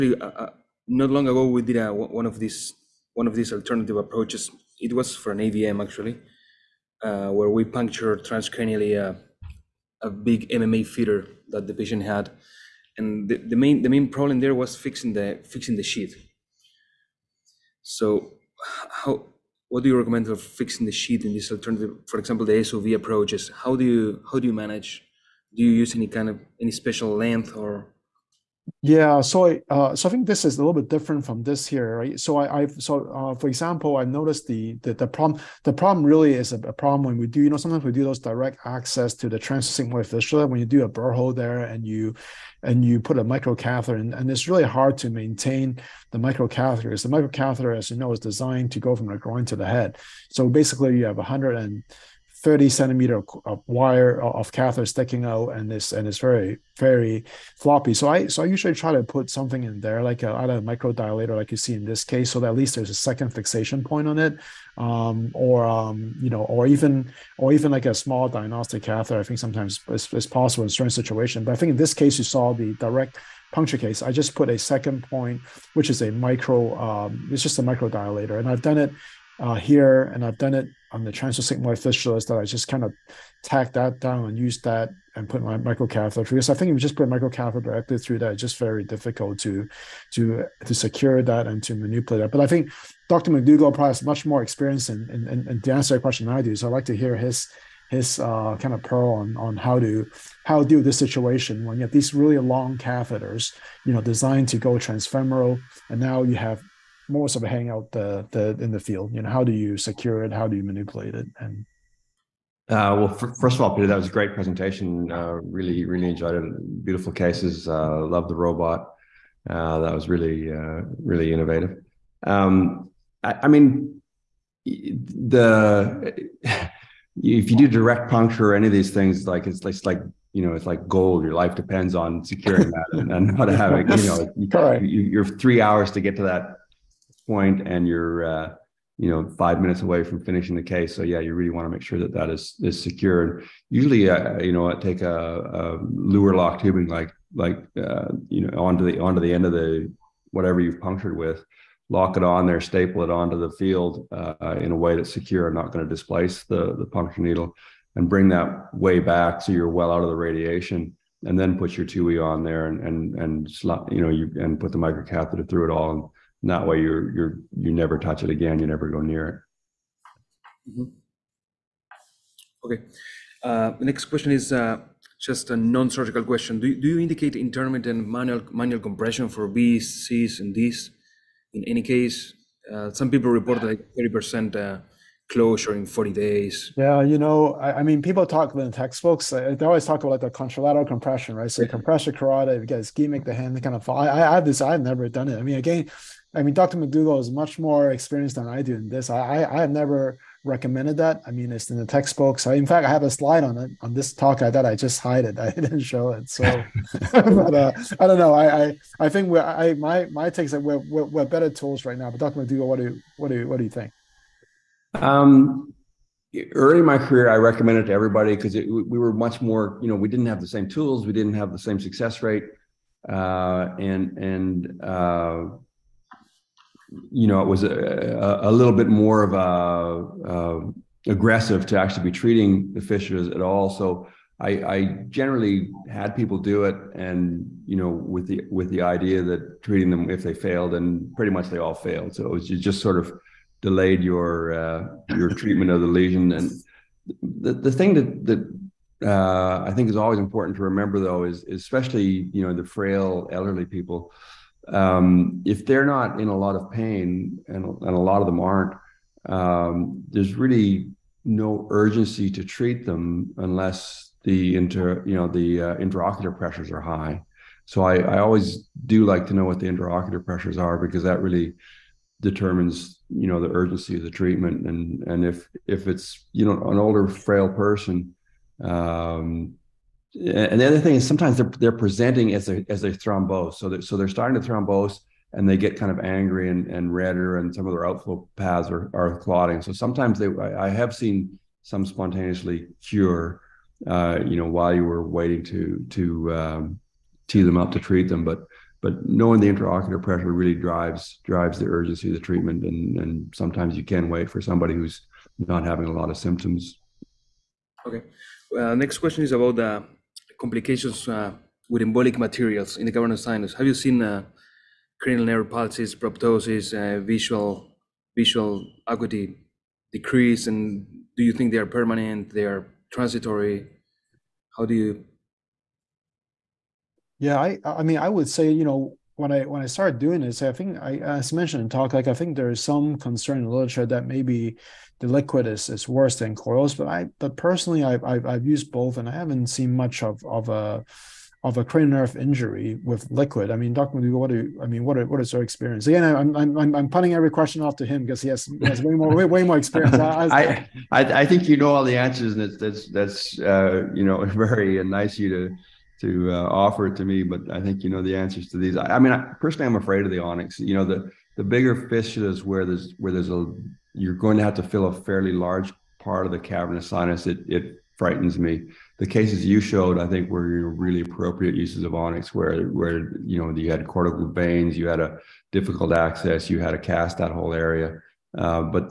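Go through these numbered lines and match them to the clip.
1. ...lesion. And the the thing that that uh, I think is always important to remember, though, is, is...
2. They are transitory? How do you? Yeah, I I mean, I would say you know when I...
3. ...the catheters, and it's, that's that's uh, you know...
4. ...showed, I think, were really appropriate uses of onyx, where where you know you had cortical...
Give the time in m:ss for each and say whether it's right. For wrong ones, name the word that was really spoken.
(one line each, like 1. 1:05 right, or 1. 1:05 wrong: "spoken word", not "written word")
1. 4:05 right
2. 5:22 right
3. 5:51 wrong: "answers", not "catheters"
4. 6:09 right.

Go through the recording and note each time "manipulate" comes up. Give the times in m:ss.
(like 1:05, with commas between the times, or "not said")
1:31, 1:50.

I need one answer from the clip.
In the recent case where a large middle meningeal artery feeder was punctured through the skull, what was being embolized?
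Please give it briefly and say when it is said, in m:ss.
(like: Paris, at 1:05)
AVM, at 0:05.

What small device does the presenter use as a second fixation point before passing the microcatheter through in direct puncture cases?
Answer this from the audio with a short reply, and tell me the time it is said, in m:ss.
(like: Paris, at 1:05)
micro dilator, at 1:17.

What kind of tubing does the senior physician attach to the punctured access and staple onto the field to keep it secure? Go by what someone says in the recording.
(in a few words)
Luer lock tubing.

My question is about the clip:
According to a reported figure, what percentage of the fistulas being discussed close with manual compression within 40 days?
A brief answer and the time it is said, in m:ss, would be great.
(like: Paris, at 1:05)
30 percent, at 3:03.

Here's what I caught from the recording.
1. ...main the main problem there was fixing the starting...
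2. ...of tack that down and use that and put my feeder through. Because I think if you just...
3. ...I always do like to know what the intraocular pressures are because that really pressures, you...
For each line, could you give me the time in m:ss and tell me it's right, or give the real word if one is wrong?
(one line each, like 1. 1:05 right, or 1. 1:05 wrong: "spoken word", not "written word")
1. 0:13 wrong: "fixing", not "starting"
2. 1:22 wrong: "microcatheter", not "feeder"
3. 4:27 wrong: "determines", not "pressures".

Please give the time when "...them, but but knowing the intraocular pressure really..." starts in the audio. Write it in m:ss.
4:58.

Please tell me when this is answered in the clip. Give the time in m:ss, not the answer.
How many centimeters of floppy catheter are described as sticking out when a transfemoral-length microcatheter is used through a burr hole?
0:51.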